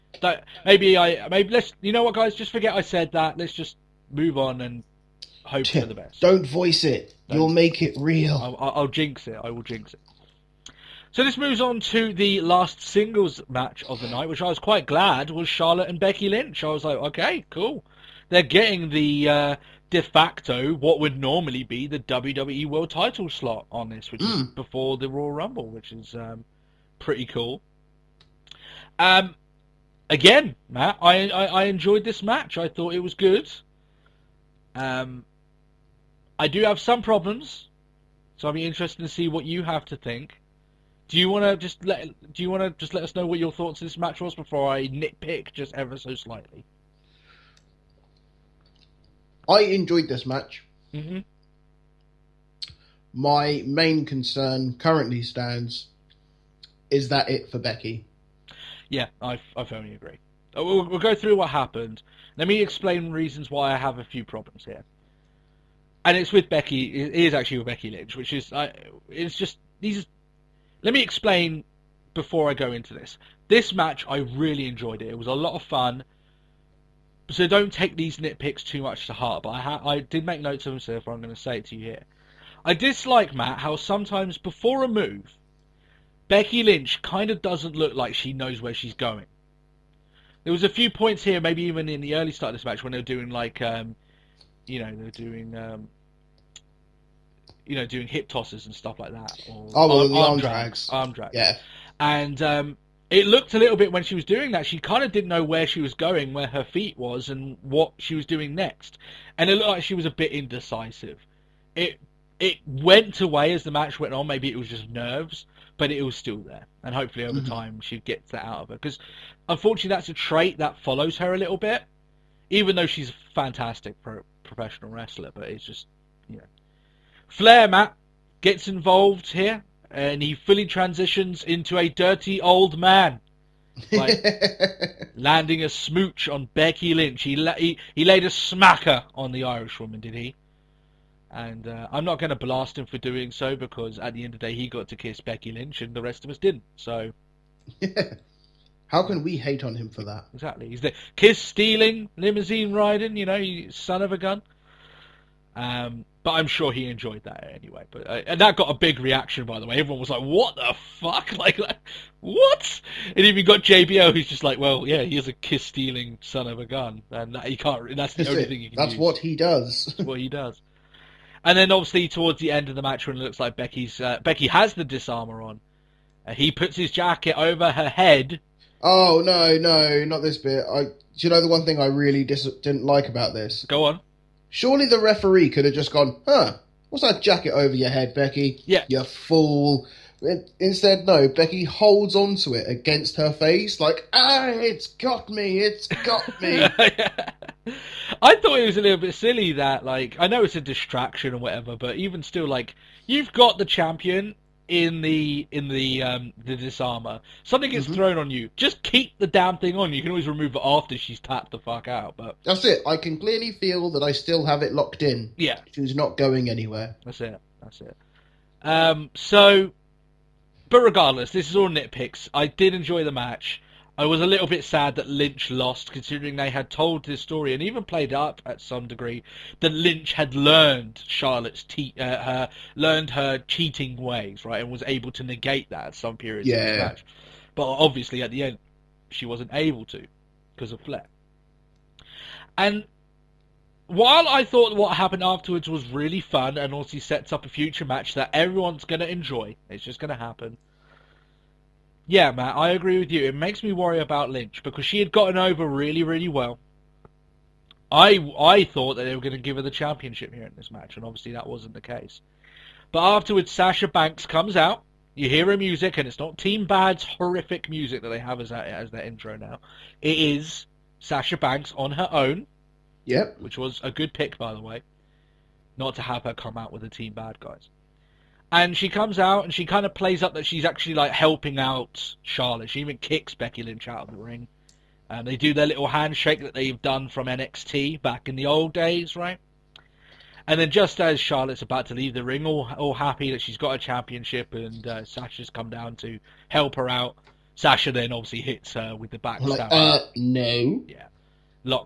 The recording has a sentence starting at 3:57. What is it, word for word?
But obviously, at the end, she wasn't able to because of Flair.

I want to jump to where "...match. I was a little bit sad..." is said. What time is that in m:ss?
3:43.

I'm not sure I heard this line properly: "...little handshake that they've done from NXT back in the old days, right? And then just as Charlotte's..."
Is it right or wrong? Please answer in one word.
right.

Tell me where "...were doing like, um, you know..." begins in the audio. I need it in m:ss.
1:32.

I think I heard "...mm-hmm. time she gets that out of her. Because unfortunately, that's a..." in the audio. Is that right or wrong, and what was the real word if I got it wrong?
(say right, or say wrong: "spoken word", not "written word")
right.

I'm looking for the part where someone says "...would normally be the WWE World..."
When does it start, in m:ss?
0:20.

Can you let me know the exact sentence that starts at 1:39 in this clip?
Or oh, well, arm, arm drags.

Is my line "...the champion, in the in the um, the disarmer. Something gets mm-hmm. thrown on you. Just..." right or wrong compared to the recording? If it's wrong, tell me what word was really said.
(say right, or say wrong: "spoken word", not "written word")
right.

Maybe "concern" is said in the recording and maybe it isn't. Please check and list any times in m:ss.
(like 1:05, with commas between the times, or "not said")
0:54.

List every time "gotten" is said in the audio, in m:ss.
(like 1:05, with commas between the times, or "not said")
4:15.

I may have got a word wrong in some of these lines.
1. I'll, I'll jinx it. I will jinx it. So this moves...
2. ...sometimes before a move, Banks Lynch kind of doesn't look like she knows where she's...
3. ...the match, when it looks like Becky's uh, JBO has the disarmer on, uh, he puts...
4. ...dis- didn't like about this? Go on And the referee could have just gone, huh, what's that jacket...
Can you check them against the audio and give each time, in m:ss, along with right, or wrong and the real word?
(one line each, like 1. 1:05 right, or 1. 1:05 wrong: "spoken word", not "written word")
1. 0:08 right
2. 1:23 wrong: "Becky", not "Banks"
3. 2:52 wrong: "Becky", not "JBO"
4. 3:02 wrong: "Surely", not "And".